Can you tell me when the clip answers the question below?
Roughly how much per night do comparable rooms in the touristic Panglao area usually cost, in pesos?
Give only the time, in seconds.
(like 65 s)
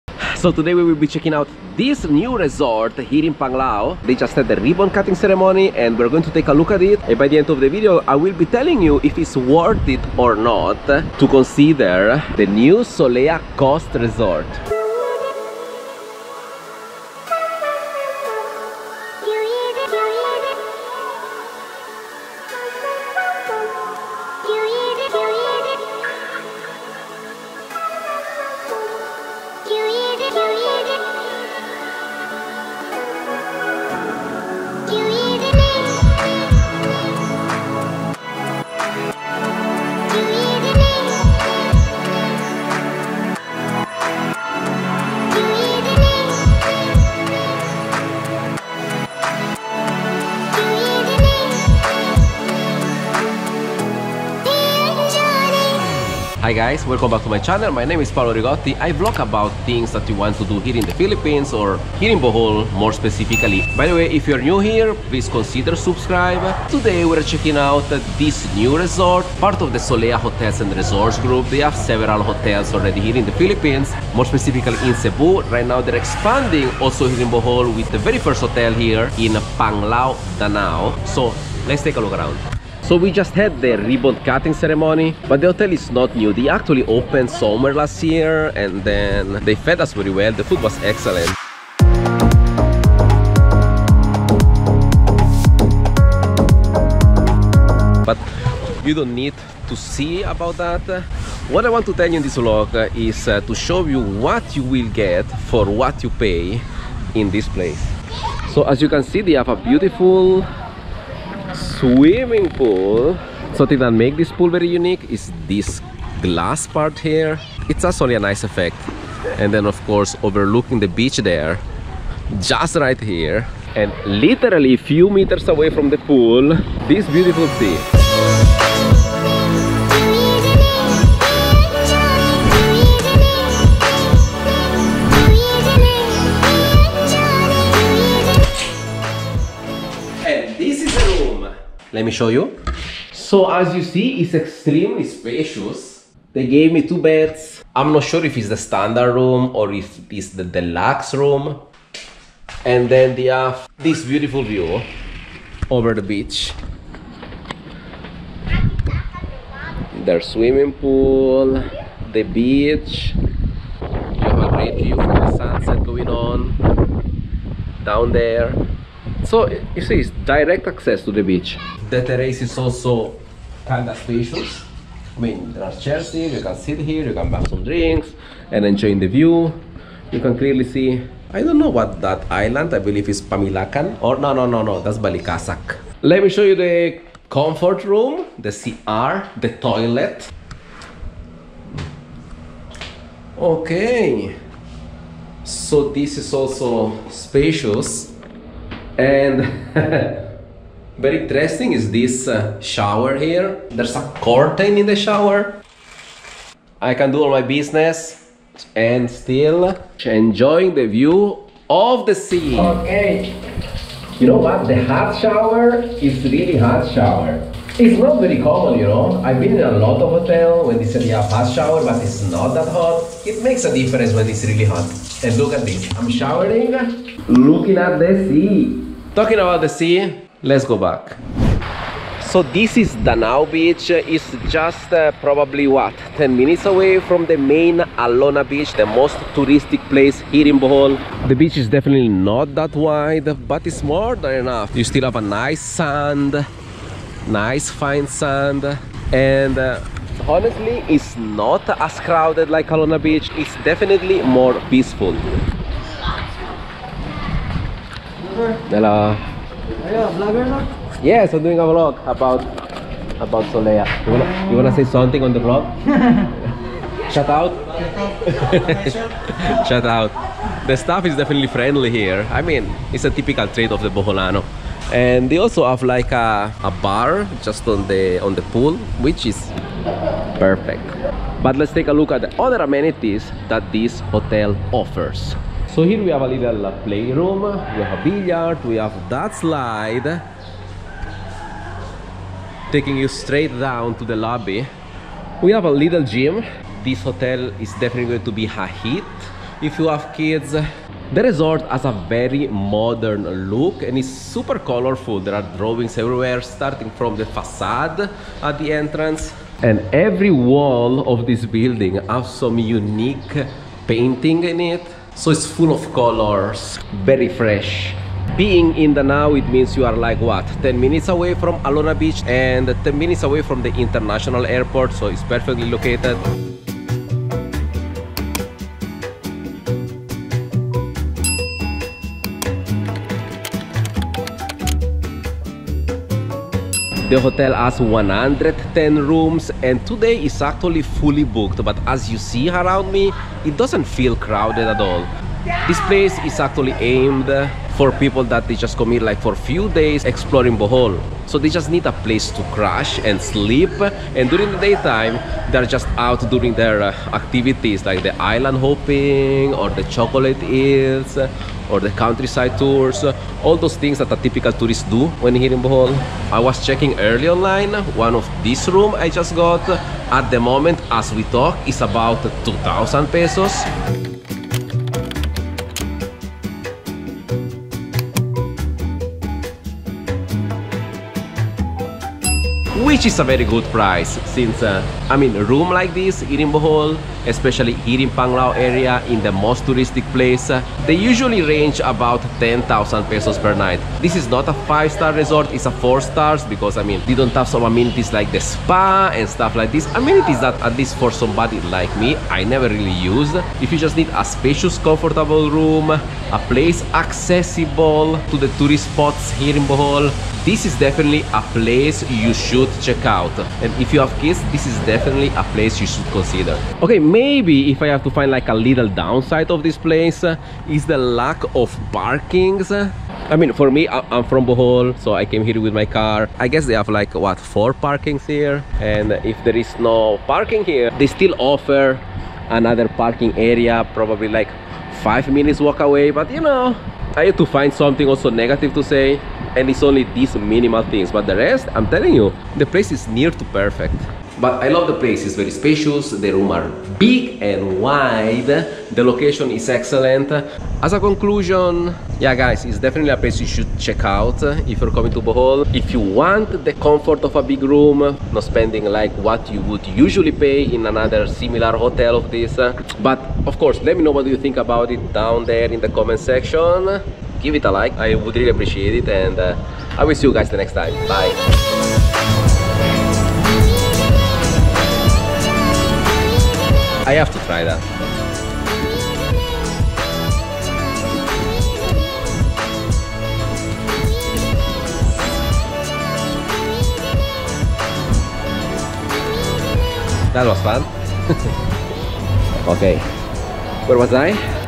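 392 s.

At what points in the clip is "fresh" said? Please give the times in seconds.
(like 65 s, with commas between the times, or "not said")
317 s.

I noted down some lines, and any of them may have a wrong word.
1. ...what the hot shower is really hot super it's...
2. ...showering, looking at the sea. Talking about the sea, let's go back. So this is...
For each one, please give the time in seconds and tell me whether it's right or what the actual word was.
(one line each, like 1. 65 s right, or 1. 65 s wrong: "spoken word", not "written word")
1. 214 s wrong: "shower", not "super"
2. 226 s right.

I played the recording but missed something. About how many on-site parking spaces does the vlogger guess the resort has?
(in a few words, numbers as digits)
4.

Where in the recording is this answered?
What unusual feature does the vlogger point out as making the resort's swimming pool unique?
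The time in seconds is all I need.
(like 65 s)
116 s.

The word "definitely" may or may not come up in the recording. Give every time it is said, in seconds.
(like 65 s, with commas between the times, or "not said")
241 s, 253 s, 271 s, 297 s, 410 s, 414 s, 452 s.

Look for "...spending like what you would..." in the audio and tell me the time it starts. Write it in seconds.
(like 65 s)
458 s.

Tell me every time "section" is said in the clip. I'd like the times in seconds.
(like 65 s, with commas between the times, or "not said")
466 s.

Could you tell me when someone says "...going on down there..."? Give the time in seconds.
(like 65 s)
165 s.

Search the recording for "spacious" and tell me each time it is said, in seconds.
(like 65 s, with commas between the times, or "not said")
145 s, 173 s, 197 s, 404 s, 445 s.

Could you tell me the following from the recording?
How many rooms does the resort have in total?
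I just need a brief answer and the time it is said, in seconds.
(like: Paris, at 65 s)
110, at 337 s.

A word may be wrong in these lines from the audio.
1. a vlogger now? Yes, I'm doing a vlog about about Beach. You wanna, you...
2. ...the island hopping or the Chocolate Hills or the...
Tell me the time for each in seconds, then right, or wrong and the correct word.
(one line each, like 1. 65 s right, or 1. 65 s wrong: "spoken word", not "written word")
1. 259 s wrong: "Solea", not "Beach"
2. 358 s right.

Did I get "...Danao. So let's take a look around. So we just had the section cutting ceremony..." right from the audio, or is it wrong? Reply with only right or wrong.
wrong.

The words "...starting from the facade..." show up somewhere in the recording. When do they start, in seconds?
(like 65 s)
306 s.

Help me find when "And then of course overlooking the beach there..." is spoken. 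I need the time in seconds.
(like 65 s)
119 s.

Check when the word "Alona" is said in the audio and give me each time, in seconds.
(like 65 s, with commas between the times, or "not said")
237 s, 252 s, 321 s.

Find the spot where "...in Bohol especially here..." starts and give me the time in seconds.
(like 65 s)
386 s.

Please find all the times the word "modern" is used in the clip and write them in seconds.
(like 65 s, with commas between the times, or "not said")
302 s.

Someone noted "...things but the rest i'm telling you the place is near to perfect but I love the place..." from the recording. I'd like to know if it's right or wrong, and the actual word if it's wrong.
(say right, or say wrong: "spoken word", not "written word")
right.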